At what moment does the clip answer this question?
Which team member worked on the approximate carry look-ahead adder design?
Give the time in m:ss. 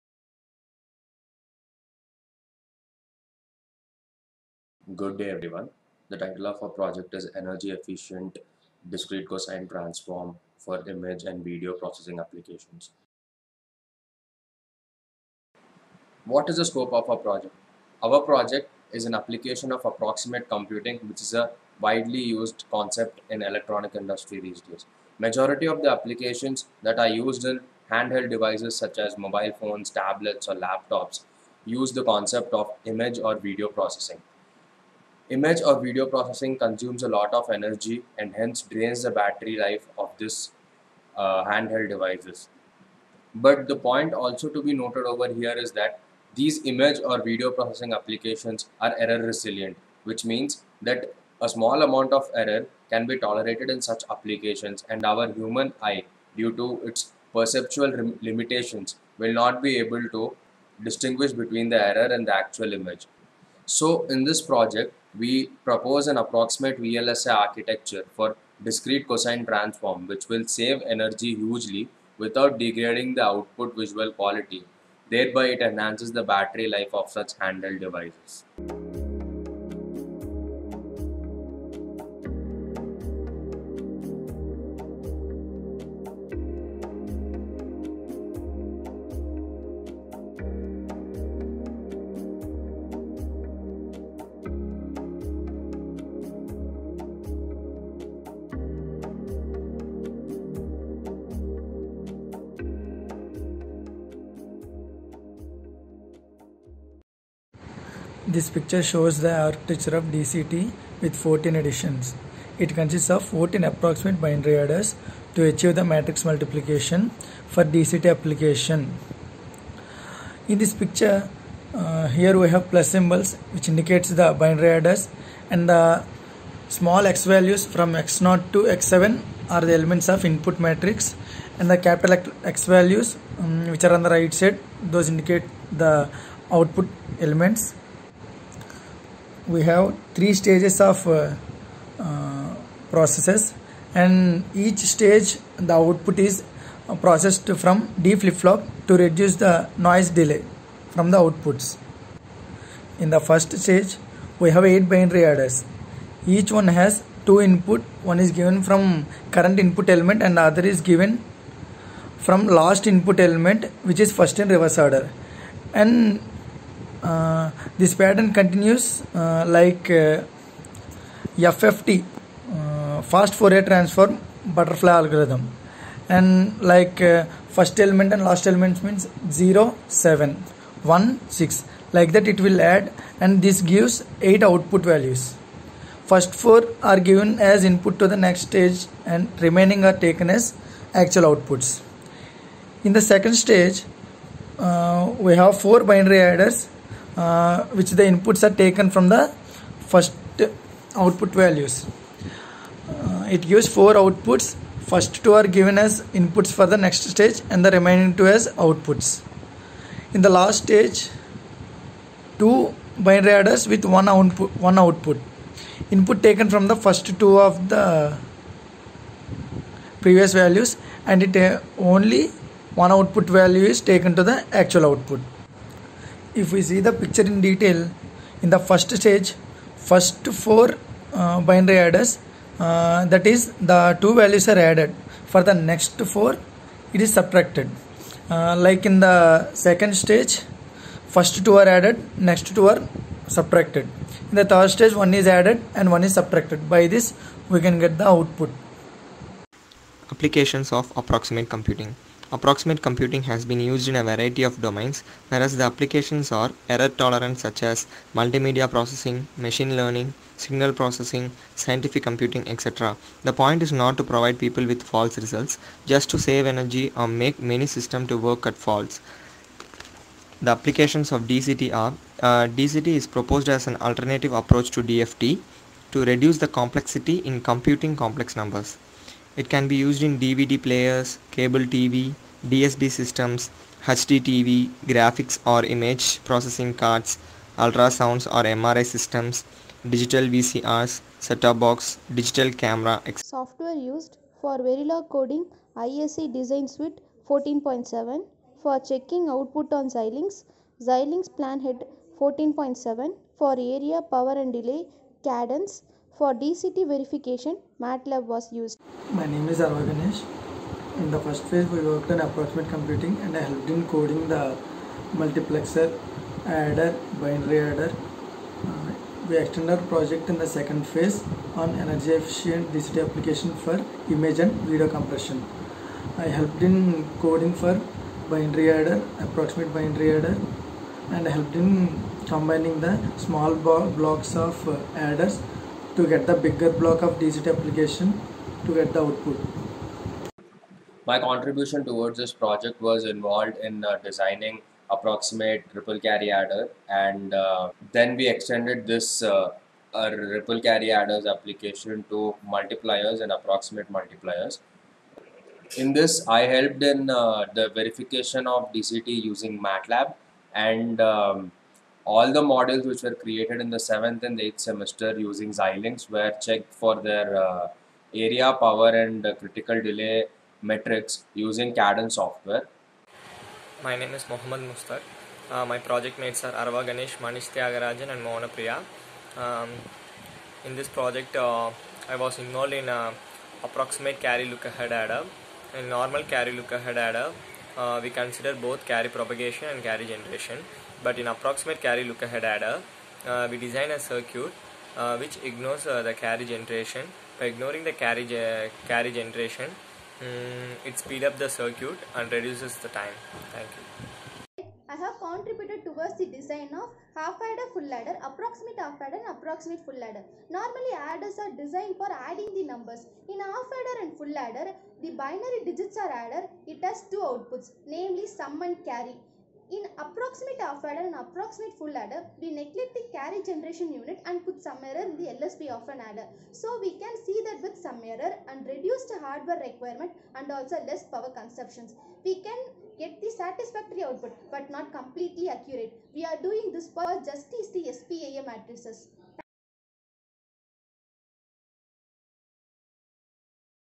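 6:14.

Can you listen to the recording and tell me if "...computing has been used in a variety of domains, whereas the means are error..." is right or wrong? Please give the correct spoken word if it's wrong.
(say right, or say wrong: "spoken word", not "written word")
wrong: "applications", not "means".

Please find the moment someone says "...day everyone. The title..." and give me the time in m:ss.
0:05.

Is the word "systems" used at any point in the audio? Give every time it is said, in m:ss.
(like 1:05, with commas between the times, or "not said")
4:27, 4:42, 4:48.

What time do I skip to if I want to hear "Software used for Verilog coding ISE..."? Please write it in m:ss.
4:53.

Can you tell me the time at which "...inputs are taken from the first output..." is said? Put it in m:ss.
3:18.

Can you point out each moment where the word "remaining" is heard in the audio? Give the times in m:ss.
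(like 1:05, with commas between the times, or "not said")
3:09, 3:27.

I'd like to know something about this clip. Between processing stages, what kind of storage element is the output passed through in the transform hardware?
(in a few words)
D flip-flop.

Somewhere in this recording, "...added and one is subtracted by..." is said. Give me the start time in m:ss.
4:05.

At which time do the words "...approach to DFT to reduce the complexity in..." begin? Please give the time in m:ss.
4:34.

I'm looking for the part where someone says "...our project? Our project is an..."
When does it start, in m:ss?
0:17.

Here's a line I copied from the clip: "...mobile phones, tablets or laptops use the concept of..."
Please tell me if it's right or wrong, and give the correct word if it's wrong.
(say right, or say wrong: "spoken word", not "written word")
right.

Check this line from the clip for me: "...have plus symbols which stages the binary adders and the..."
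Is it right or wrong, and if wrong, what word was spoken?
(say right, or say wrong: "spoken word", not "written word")
wrong: "indicates", not "stages".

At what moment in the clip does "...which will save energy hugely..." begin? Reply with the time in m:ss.
1:10.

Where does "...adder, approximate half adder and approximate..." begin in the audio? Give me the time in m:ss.
6:47.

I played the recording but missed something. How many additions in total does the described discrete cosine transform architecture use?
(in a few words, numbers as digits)
14.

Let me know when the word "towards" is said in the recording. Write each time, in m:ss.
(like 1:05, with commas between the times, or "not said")
5:41, 6:45.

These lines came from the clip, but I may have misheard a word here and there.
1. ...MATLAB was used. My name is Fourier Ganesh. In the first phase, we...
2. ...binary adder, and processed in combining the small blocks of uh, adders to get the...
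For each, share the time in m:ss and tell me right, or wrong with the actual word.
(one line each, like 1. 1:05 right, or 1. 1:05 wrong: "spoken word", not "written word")
1. 5:07 wrong: "Arva", not "Fourier"
2. 5:29 wrong: "helped", not "processed".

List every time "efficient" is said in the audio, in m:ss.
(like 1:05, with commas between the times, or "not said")
0:07, 5:22.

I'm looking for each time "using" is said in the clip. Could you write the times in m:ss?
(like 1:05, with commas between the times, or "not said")
5:59, 6:05, 6:11.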